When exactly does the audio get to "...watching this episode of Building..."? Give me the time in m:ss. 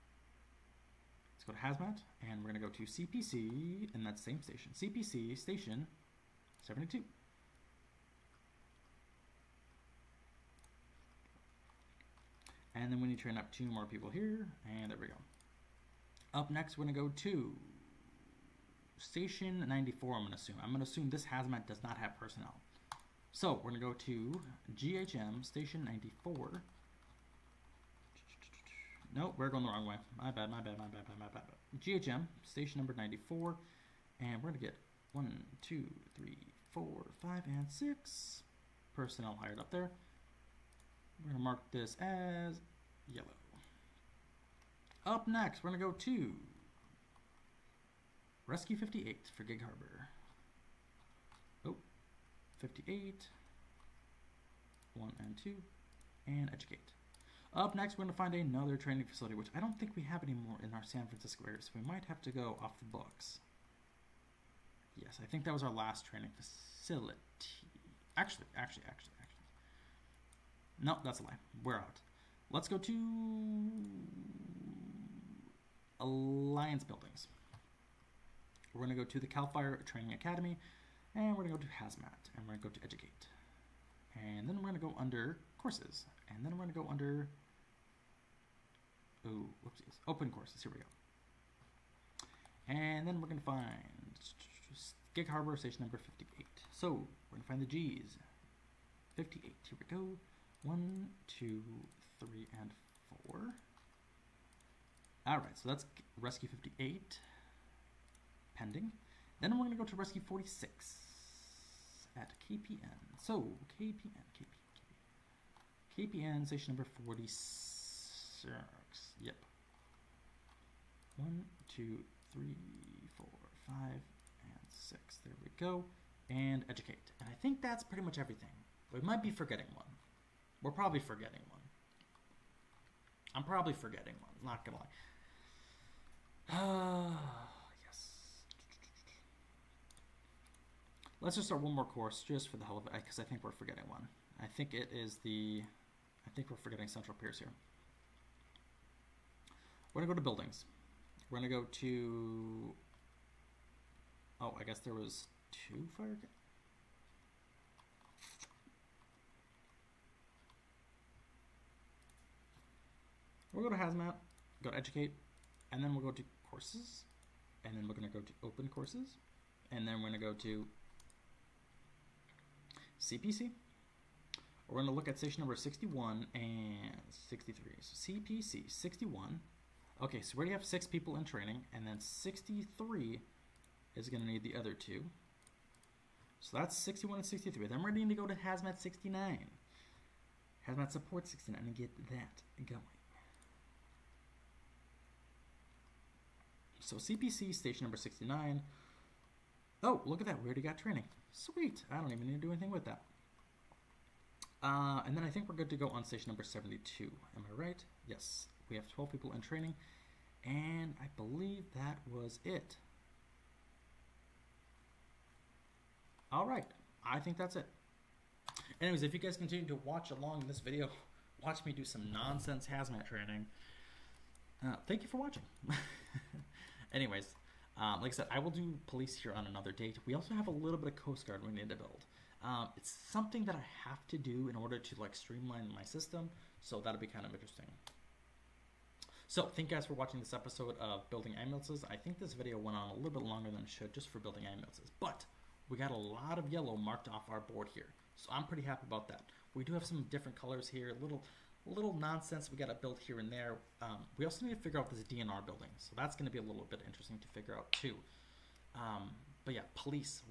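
3:59.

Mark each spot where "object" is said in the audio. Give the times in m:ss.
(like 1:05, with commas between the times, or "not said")
not said.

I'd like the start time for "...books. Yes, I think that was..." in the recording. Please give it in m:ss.
1:02.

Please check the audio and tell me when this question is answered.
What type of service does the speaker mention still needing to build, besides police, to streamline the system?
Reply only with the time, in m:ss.
3:50.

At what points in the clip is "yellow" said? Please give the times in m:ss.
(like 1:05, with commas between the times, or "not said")
0:43, 4:06.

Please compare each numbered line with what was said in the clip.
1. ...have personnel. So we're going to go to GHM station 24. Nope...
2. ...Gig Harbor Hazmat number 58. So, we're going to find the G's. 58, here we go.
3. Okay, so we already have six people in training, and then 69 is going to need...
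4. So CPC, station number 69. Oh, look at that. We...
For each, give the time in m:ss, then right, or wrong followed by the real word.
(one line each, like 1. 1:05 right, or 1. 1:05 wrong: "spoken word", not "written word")
1. 0:21 wrong: "94", not "24"
2. 1:35 wrong: "Station", not "Hazmat"
3. 3:00 wrong: "63", not "69"
4. 3:16 right.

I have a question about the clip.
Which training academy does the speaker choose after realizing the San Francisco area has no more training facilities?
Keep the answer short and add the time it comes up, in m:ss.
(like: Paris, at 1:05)
CAL FIRE Training Academy, at 1:19.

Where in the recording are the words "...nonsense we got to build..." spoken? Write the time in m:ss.
4:11.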